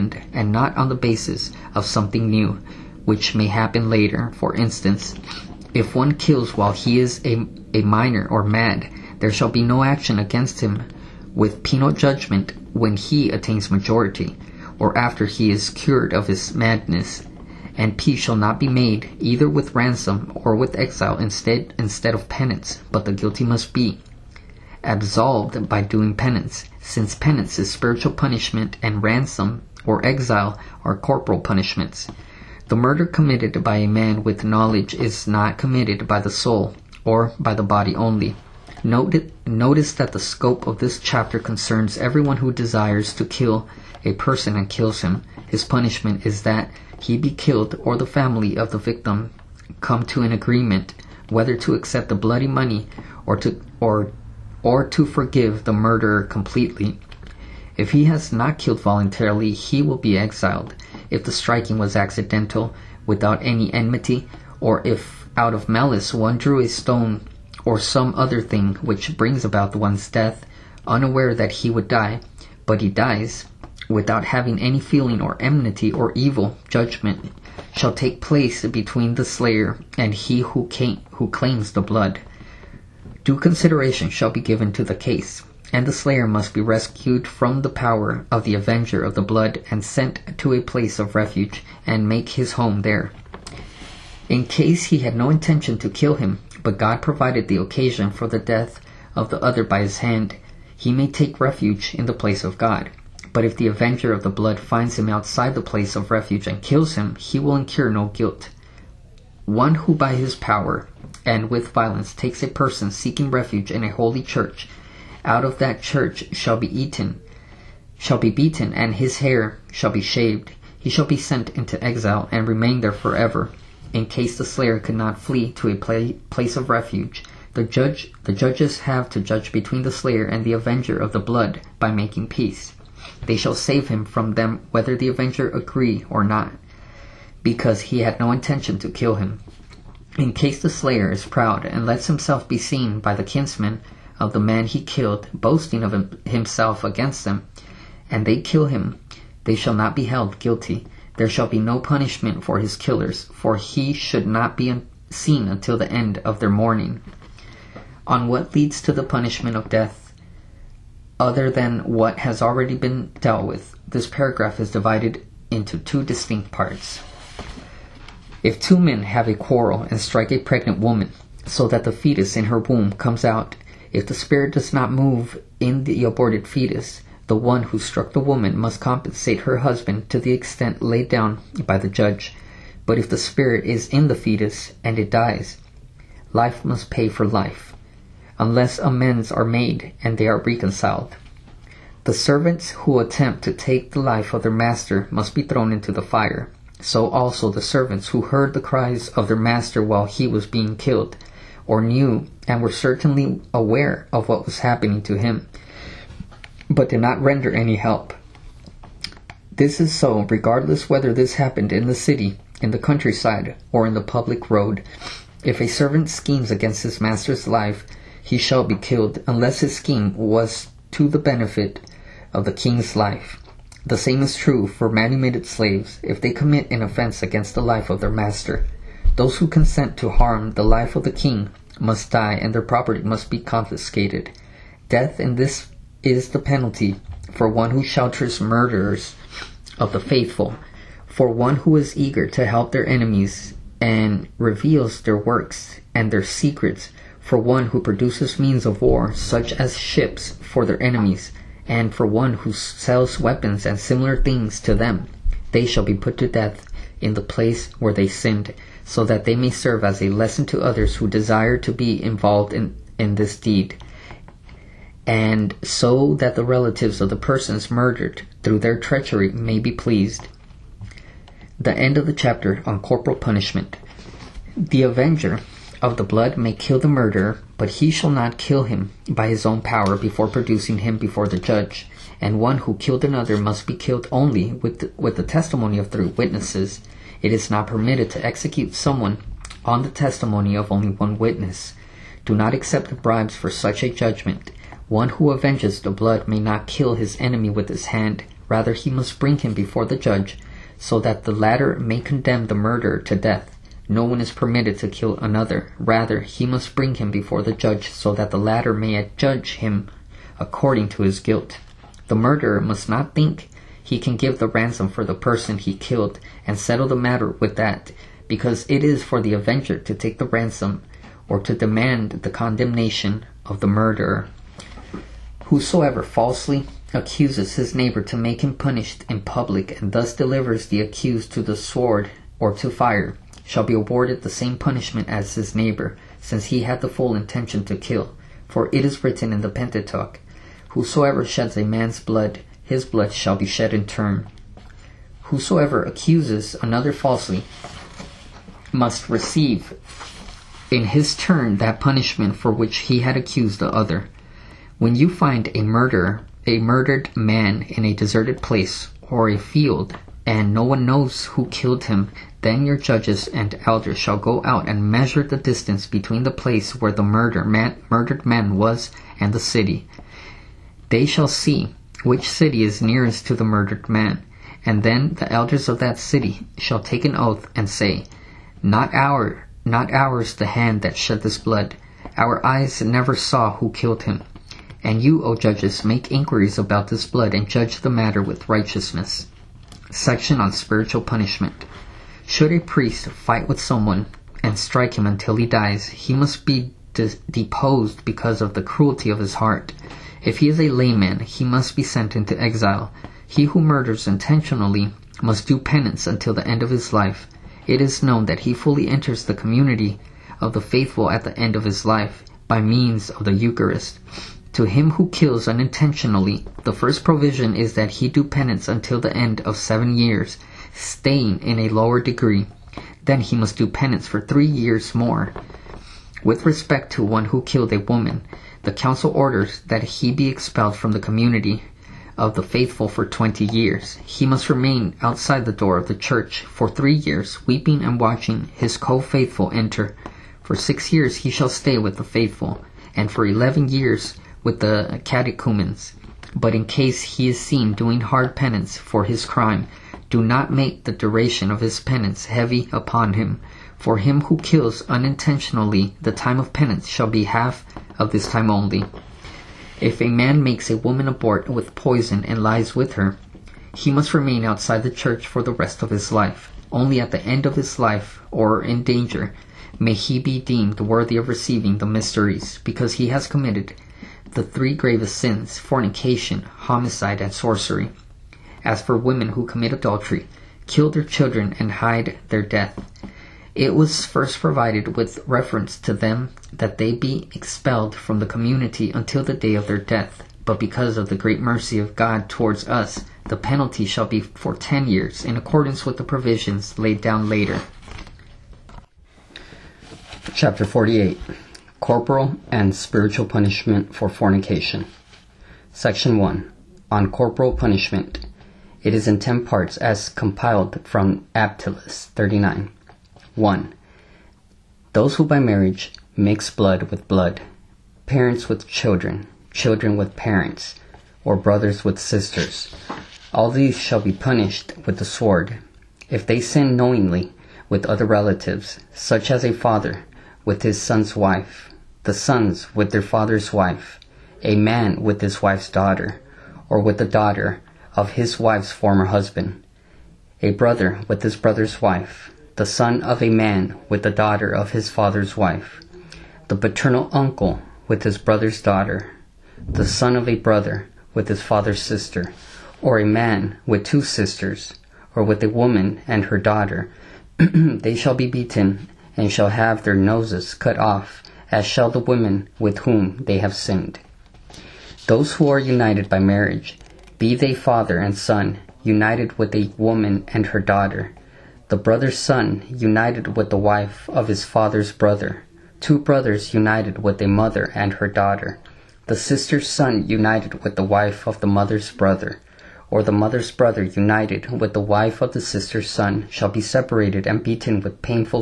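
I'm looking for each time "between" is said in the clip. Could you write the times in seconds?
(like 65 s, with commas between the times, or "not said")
78 s, 129 s, 365 s.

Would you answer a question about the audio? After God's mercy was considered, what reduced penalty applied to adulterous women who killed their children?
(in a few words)
10 years.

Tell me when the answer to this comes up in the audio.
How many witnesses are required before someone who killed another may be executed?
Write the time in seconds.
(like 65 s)
285 s.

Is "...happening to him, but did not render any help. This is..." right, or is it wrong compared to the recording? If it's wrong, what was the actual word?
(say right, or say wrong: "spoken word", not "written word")
right.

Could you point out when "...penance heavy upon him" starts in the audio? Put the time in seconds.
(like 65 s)
451 s.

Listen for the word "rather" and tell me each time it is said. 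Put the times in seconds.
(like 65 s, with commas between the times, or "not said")
298 s, 305 s.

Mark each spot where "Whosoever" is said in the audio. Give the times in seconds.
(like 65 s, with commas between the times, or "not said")
325 s, 340 s, 345 s.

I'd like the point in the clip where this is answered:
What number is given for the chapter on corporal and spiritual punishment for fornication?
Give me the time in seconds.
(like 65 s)
500 s.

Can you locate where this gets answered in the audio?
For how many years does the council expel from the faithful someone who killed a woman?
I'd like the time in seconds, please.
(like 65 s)
433 s.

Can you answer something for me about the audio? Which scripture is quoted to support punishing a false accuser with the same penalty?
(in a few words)
Pentateuch.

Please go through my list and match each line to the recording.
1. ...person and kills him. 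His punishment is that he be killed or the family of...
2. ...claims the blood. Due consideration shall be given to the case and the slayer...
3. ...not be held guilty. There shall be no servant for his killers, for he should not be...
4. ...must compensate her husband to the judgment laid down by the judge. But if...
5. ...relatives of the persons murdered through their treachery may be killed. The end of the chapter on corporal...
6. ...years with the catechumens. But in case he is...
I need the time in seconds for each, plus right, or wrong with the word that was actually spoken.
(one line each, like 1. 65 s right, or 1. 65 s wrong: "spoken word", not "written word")
1. 44 s right
2. 81 s right
3. 149 s wrong: "punishment", not "servant"
4. 178 s wrong: "extent", not "judgment"
5. 266 s wrong: "pleased", not "killed"
6. 443 s right.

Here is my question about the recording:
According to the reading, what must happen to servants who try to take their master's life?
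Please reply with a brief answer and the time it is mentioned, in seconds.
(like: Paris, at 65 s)
Thrown into the fire, at 195 s.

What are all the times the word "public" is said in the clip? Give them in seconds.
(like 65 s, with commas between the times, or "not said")
214 s, 329 s.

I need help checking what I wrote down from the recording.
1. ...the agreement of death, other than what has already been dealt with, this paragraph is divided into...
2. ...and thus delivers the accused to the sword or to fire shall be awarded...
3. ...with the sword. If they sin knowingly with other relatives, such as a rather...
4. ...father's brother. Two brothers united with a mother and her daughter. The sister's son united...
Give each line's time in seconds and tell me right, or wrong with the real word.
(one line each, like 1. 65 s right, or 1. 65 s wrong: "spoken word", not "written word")
1. 158 s wrong: "punishment", not "agreement"
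2. 329 s right
3. 524 s wrong: "father", not "rather"
4. 574 s right.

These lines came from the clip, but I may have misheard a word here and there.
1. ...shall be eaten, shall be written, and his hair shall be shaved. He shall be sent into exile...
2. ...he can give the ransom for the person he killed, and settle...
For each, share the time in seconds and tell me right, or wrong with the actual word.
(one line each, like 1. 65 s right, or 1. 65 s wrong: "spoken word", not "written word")
1. 116 s wrong: "beaten", not "written"
2. 313 s right.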